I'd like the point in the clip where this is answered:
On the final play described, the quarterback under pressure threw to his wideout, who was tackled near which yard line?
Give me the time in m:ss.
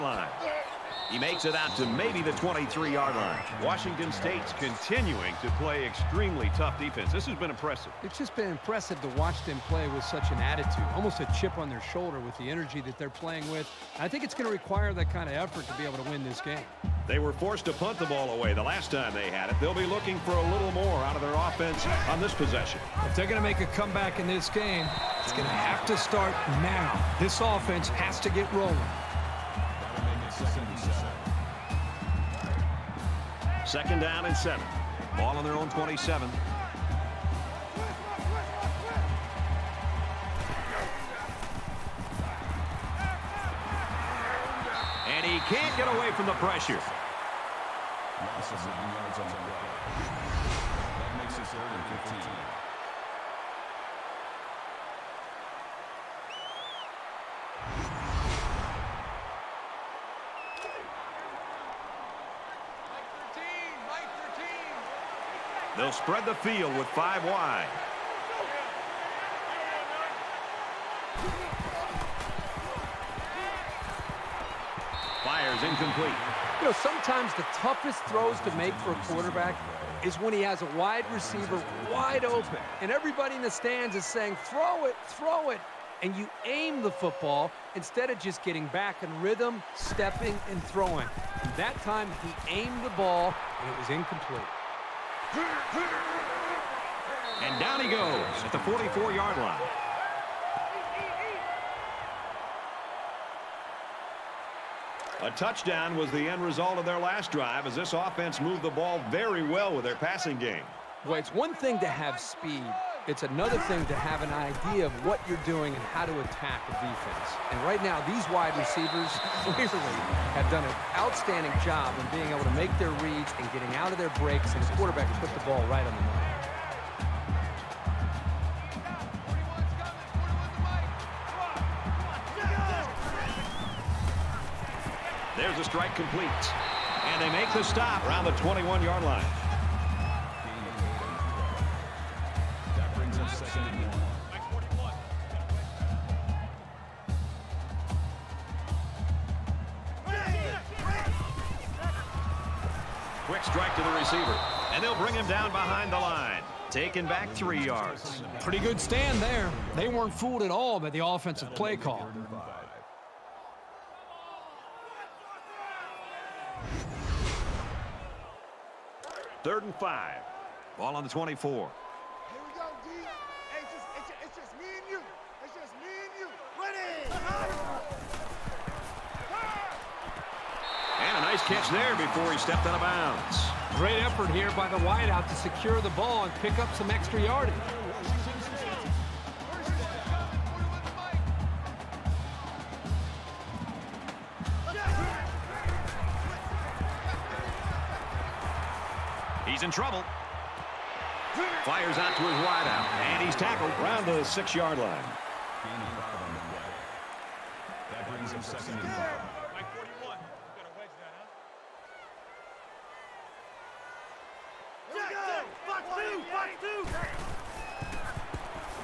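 3:24.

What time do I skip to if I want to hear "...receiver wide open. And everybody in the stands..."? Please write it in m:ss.
1:21.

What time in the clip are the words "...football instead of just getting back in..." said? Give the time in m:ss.
1:26.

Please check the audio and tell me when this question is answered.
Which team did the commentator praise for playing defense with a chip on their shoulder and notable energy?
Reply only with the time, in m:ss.
0:03.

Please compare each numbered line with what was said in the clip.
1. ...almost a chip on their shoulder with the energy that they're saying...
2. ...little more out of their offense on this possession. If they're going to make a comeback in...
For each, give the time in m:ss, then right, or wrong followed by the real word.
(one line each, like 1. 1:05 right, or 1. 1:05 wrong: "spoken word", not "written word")
1. 0:10 wrong: "playing", not "saying"
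2. 0:20 right.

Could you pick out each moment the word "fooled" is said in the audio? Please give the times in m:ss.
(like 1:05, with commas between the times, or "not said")
2:40.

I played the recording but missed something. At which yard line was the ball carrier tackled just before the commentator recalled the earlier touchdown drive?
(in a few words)
44.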